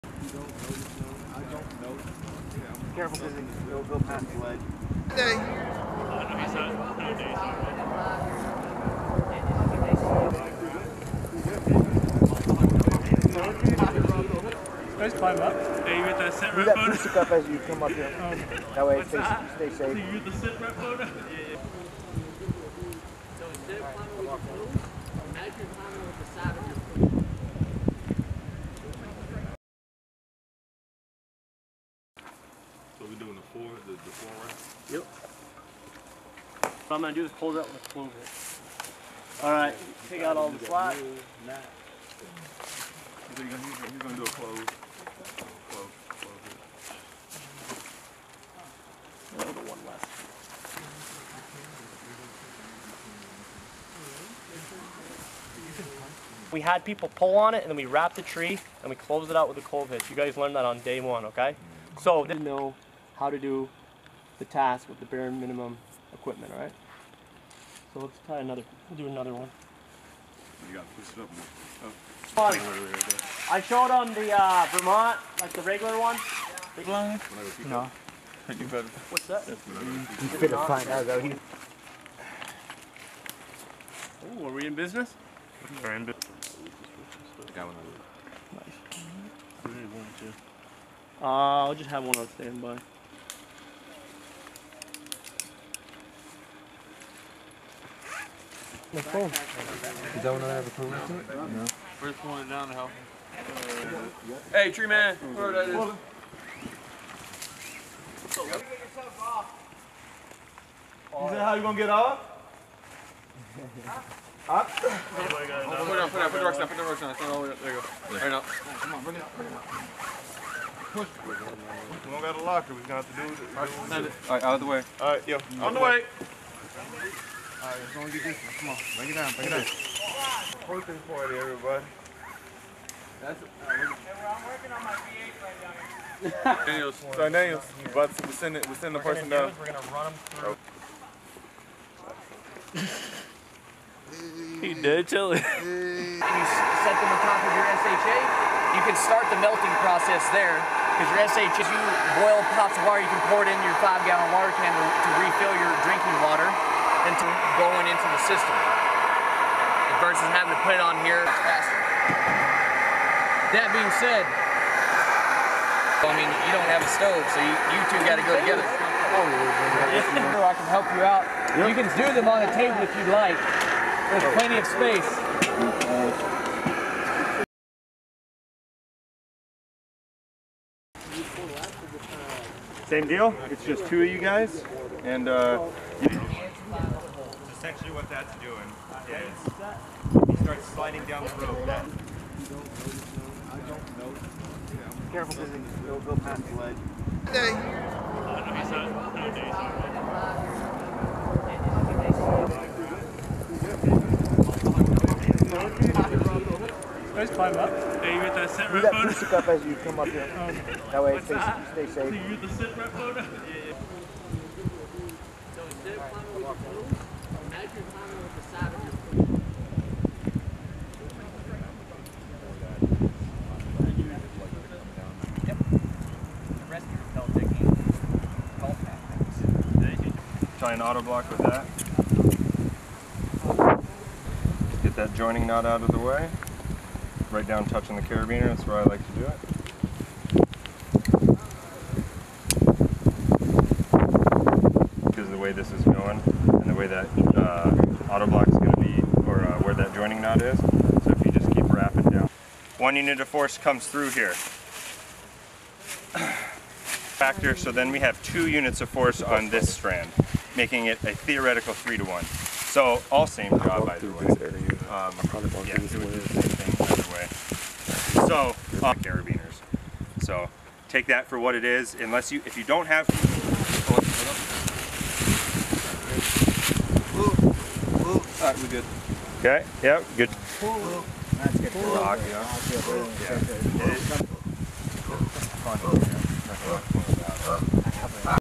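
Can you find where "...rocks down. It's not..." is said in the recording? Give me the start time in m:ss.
1:56.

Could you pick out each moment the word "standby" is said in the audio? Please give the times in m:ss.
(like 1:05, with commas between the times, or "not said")
1:32.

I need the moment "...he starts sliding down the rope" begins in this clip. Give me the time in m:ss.
3:10.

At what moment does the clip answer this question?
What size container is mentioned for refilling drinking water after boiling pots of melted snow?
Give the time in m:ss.
2:33.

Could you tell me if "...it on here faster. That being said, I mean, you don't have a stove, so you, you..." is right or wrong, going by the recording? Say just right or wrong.
right.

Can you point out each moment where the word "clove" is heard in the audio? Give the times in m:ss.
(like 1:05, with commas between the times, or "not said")
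0:37, 0:59.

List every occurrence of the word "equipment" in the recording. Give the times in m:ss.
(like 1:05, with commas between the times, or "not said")
1:06.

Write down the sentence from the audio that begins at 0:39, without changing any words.
All right, take out all the slack.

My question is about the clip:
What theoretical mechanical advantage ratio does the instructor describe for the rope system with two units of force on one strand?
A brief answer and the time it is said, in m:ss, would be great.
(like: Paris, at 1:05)
3 to 1, at 4:21.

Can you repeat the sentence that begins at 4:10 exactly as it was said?
So if you just keep wrapping down.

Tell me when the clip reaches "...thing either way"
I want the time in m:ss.
4:26.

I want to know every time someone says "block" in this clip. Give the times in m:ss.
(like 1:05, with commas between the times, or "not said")
3:51, 4:08.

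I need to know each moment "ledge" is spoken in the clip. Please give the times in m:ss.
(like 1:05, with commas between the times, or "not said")
0:04, 3:16.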